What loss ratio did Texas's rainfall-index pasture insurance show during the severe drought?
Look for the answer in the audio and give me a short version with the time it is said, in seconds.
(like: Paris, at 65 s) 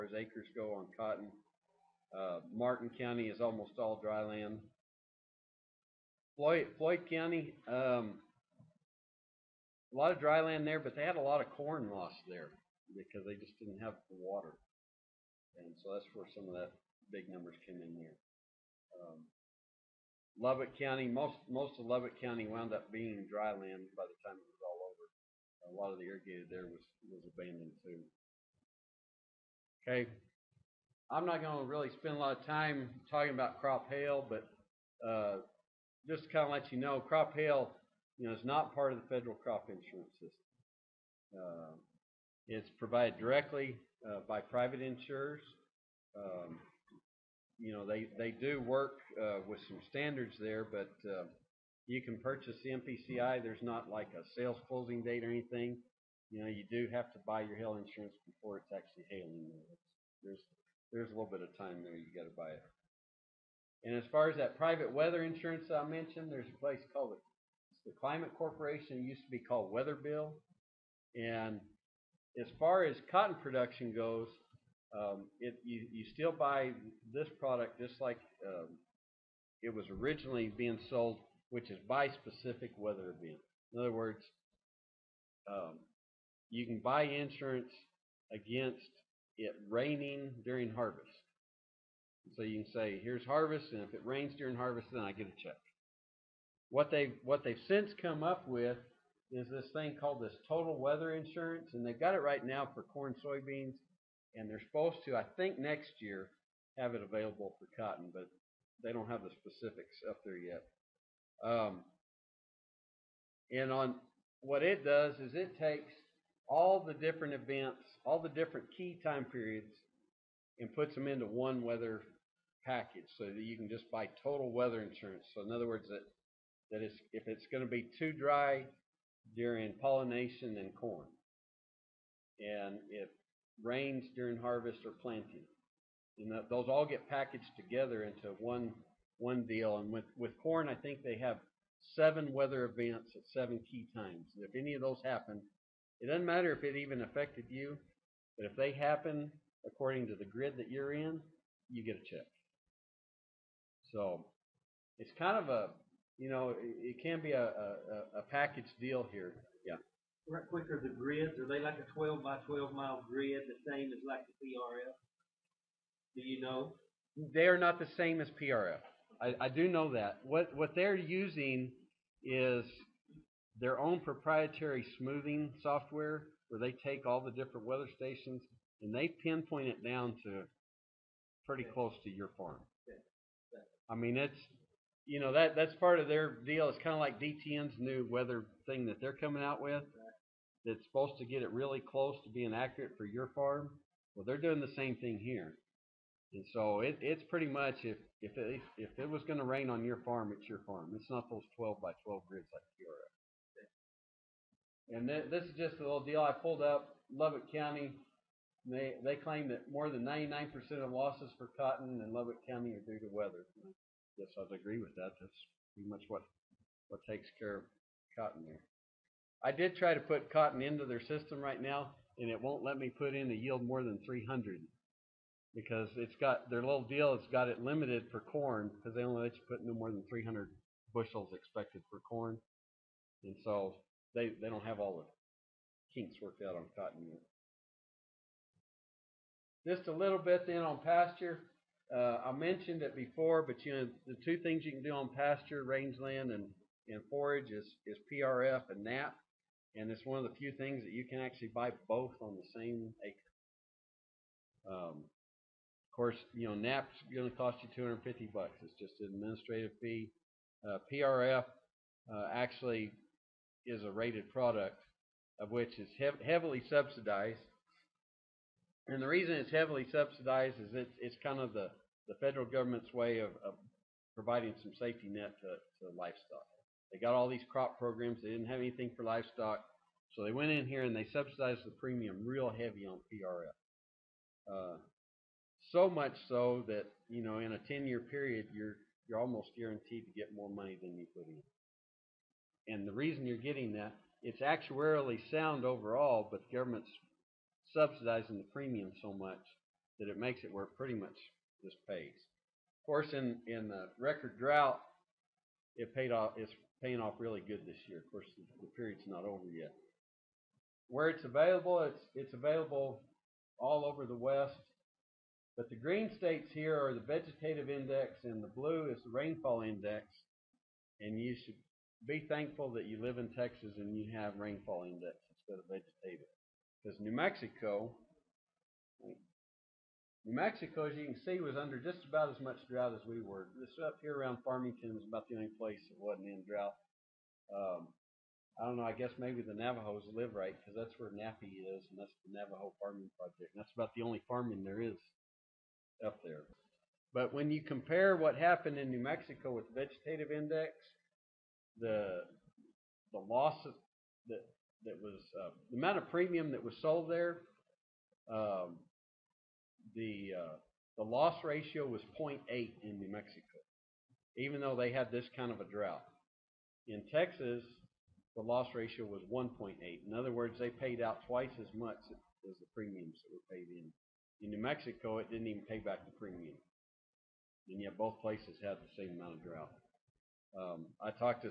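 1.8, at 369 s.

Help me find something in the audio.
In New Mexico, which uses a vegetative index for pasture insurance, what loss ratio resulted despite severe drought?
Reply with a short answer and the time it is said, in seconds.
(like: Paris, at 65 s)
0.8, at 362 s.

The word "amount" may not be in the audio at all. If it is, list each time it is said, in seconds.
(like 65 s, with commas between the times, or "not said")
355 s, 379 s.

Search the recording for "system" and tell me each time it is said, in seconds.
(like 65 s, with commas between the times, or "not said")
40 s, 221 s.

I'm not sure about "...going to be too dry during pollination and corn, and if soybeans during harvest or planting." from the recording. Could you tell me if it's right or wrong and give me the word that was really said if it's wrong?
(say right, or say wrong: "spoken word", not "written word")
wrong: "rains", not "soybeans".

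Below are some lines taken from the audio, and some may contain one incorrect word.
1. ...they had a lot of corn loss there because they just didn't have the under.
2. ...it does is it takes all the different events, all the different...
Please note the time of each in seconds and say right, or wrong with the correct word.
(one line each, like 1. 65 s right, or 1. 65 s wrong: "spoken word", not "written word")
1. 10 s wrong: "water", not "under"
2. 114 s right.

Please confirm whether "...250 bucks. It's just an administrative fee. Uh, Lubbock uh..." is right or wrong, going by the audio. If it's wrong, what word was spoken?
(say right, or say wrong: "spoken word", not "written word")
wrong: "PRF", not "Lubbock".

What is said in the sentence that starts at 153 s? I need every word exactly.
So it's kind of a, you know, it can be a, a, a package deal here right quicker the grids?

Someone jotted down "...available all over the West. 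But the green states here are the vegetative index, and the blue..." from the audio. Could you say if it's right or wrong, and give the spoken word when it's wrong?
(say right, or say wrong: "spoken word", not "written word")
right.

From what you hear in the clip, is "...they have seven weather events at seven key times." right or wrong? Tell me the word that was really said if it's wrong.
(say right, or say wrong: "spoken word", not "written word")
right.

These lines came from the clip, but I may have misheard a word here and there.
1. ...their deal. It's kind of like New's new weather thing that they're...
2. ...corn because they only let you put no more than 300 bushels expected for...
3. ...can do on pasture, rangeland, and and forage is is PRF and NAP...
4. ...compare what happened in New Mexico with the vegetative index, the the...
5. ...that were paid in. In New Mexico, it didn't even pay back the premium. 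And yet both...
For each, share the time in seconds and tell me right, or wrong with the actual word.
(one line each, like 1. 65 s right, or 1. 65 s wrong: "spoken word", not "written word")
1. 186 s wrong: "DTN", not "New"
2. 228 s right
3. 244 s right
4. 347 s right
5. 373 s right.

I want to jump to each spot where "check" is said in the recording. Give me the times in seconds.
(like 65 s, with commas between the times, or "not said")
95 s, 152 s.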